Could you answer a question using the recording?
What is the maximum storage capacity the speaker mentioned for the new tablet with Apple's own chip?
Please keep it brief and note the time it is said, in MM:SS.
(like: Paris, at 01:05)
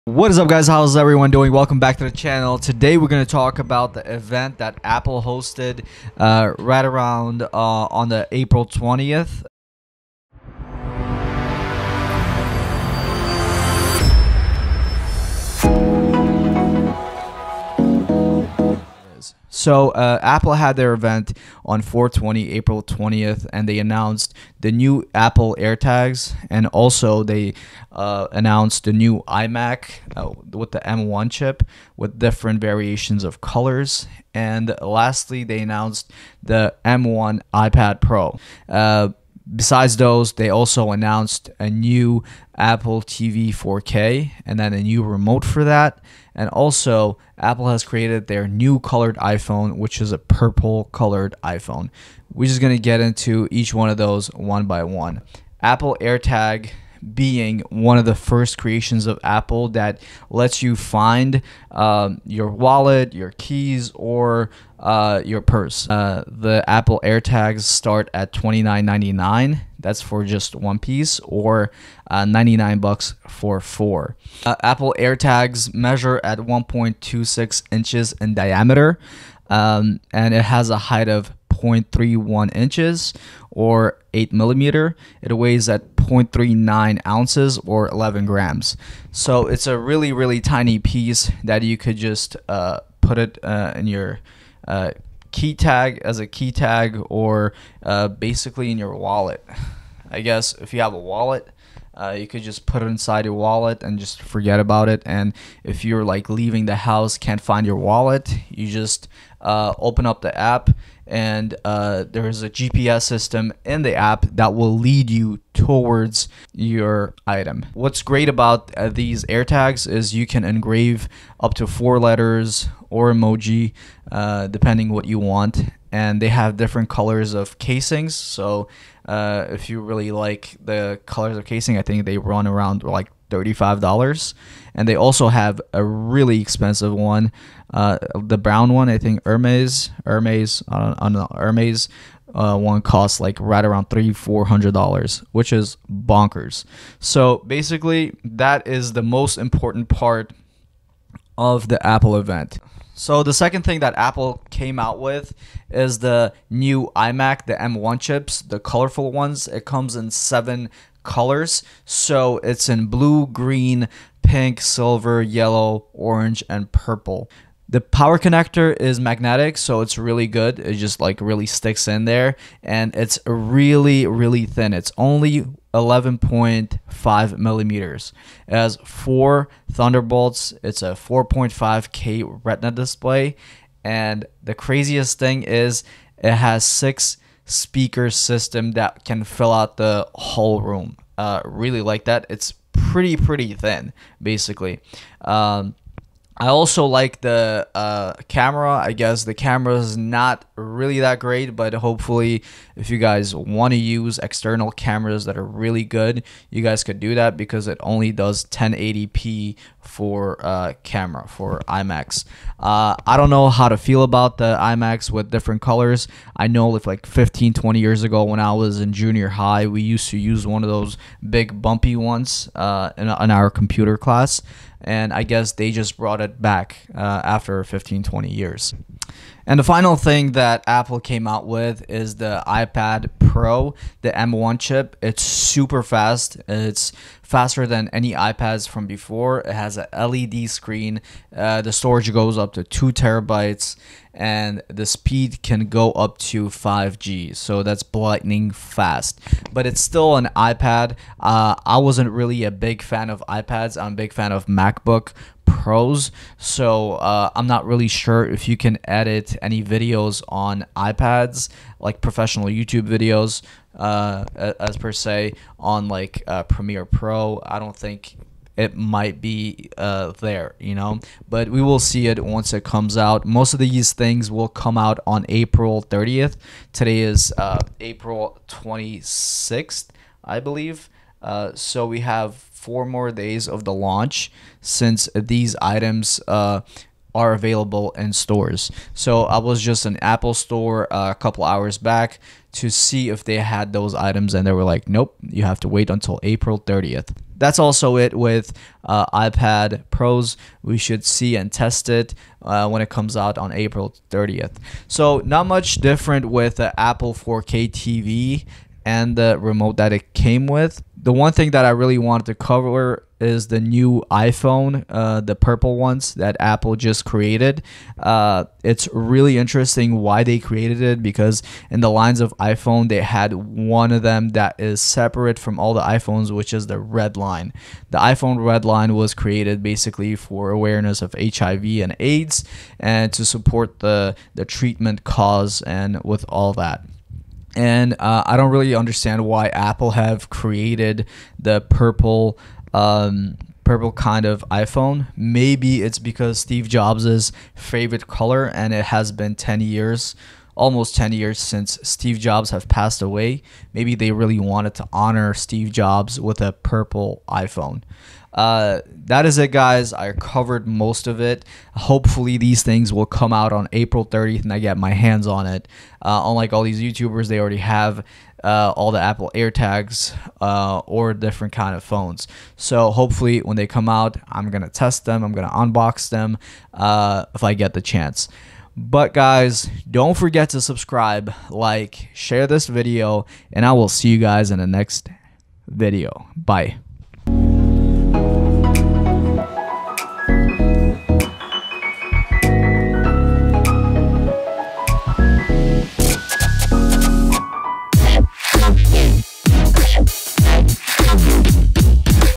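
2 terabytes, at 04:02.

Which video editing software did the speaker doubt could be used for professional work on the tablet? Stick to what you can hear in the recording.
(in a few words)
Premiere Pro.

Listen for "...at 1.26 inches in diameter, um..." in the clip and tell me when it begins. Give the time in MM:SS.
01:16.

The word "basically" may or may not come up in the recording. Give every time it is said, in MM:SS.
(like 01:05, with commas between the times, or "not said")
01:38, 02:27, 03:14, 05:29.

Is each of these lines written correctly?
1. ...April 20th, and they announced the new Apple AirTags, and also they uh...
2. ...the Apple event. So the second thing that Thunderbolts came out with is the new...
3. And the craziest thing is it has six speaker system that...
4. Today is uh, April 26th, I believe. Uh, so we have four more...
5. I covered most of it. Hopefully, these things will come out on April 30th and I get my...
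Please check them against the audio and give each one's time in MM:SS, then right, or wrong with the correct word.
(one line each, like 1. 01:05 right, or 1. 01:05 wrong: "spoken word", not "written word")
1. 00:22 right
2. 02:31 wrong: "Apple", not "Thunderbolts"
3. 03:03 right
4. 04:36 right
5. 05:59 right.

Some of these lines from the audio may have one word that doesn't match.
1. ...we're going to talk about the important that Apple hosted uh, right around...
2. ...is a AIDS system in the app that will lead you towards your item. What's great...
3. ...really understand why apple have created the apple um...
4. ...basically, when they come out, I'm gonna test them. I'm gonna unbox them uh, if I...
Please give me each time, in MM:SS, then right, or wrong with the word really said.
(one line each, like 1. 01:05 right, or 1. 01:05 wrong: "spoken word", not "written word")
1. 00:02 wrong: "event", not "important"
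2. 01:52 wrong: "GPS", not "AIDS"
3. 05:38 wrong: "purple", not "apple"
4. 06:12 wrong: "hopefully", not "basically".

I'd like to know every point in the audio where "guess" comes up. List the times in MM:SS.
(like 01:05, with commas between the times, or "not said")
01:40, 03:18, 03:45.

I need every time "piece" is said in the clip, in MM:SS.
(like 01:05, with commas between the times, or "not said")
01:10, 01:30.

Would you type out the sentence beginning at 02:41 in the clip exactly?
So it's in blue, green, pink, silver, yellow, orange, and purple.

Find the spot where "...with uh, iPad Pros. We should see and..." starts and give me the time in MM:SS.
04:58.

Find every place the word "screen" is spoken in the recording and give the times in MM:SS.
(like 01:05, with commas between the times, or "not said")
04:00.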